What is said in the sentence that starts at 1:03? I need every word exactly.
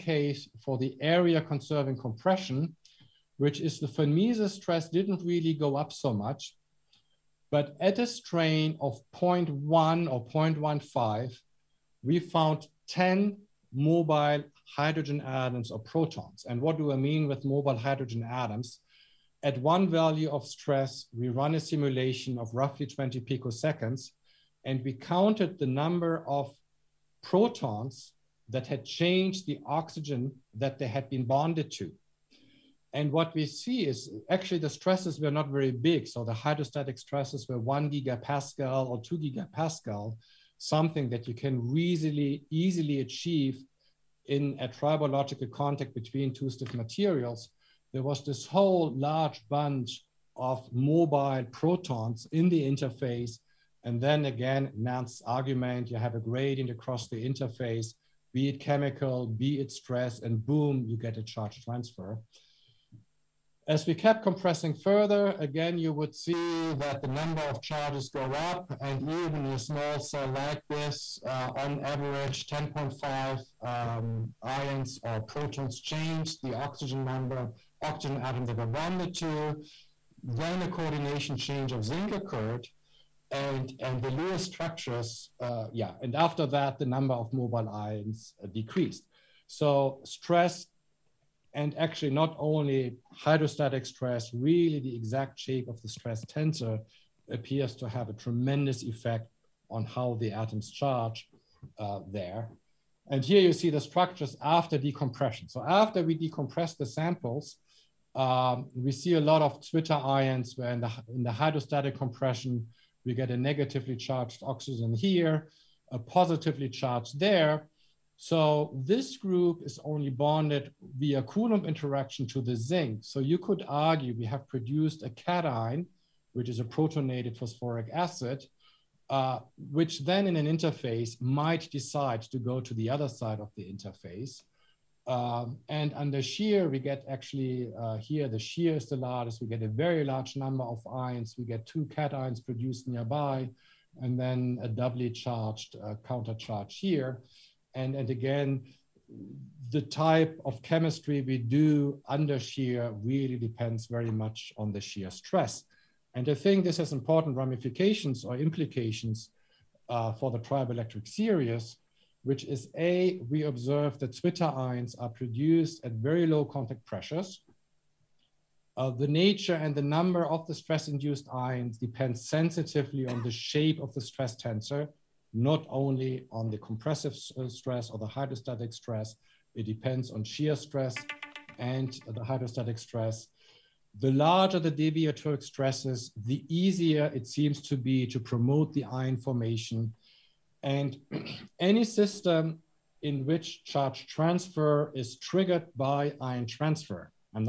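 As we kept compressing further, again, you would see that the number of charges go up.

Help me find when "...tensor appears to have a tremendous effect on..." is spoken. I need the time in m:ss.
1:36.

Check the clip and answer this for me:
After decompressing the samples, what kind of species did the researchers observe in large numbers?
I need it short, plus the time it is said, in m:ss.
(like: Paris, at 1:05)
zwitterions, at 1:49.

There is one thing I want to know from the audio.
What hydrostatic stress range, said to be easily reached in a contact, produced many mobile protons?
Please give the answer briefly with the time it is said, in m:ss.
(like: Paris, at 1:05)
1 or 2 gigapascal, at 0:37.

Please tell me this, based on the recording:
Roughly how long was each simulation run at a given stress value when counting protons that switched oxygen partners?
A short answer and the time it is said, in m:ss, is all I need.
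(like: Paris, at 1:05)
20 picoseconds, at 0:22.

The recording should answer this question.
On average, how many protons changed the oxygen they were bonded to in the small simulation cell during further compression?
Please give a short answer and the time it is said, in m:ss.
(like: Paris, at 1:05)
10.5, at 1:12.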